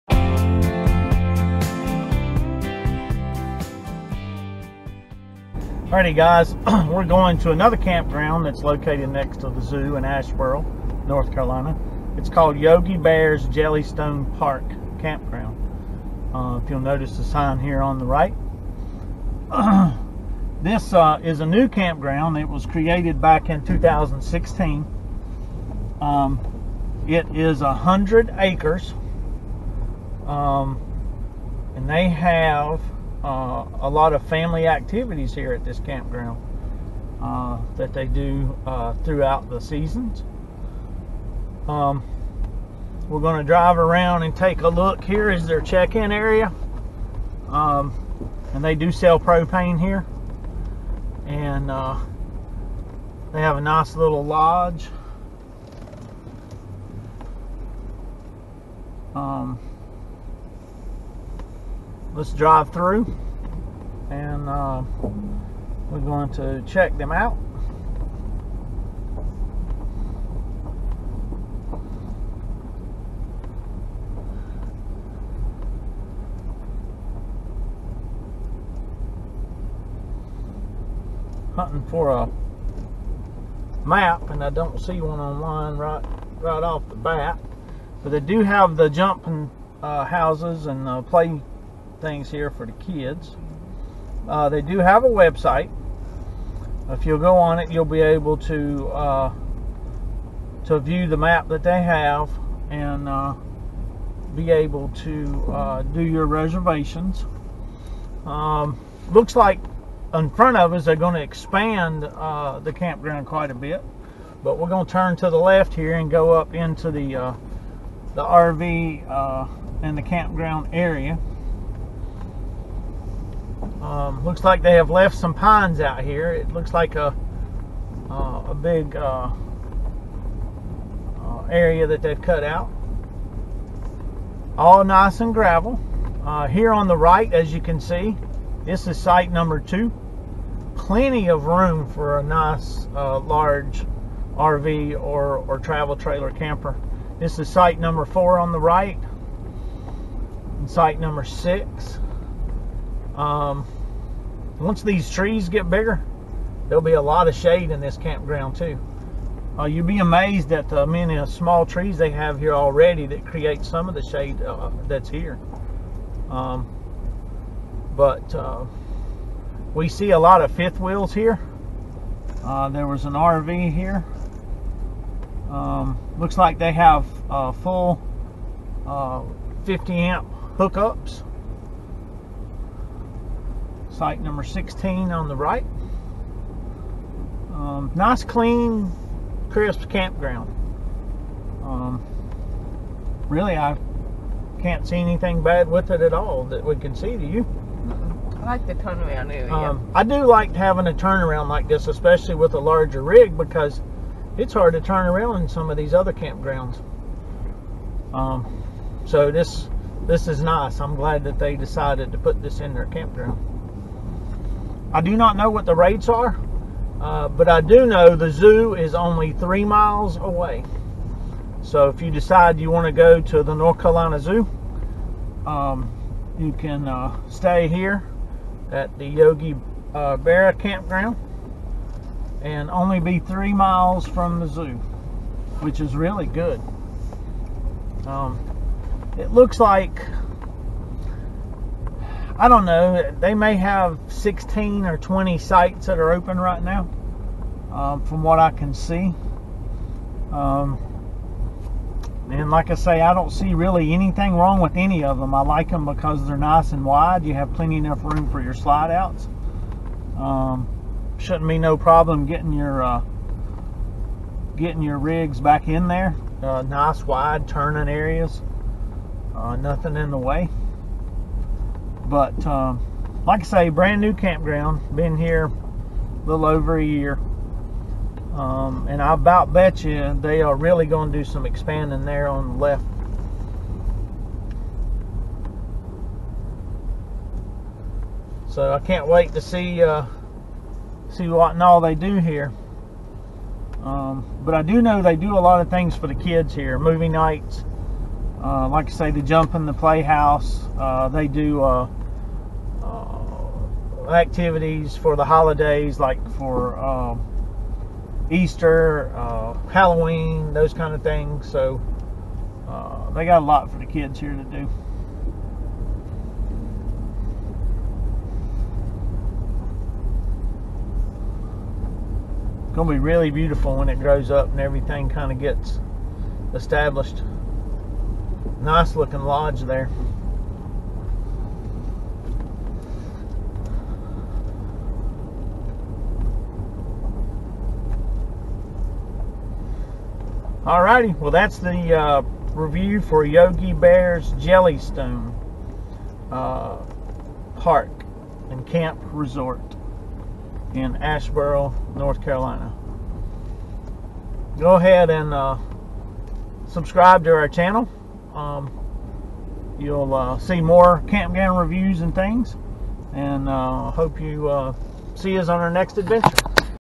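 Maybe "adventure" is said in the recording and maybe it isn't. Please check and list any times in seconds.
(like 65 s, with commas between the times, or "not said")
365 s.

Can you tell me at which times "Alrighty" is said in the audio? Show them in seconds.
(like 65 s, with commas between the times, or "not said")
5 s, 340 s.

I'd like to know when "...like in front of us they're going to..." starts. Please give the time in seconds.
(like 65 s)
109 s.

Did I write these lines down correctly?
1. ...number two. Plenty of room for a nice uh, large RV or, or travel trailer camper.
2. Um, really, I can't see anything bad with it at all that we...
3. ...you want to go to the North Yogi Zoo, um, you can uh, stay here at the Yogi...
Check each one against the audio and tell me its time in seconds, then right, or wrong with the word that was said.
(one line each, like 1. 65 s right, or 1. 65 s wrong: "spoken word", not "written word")
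1. 139 s right
2. 191 s right
3. 222 s wrong: "Carolina", not "Yogi".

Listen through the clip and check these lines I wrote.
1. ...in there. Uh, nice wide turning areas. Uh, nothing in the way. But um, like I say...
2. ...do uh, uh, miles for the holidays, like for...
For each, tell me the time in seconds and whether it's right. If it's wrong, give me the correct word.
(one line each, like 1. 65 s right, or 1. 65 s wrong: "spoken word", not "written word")
1. 265 s right
2. 301 s wrong: "activities", not "miles".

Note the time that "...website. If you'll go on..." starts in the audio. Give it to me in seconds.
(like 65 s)
95 s.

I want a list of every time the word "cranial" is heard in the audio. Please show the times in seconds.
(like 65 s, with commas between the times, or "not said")
not said.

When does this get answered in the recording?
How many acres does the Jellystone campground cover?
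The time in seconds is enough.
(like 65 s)
27 s.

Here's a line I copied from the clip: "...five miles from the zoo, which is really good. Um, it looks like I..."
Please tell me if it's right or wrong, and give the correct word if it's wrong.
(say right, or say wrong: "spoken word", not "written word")
wrong: "three", not "five".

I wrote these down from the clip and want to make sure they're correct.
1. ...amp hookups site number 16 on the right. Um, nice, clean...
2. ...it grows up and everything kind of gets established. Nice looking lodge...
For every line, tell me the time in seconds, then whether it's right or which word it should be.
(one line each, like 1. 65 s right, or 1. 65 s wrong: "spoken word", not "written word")
1. 179 s right
2. 323 s right.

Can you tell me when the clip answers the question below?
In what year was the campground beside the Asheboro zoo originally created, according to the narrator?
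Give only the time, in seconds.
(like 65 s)
23 s.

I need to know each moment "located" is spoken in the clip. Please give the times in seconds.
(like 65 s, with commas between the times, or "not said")
8 s.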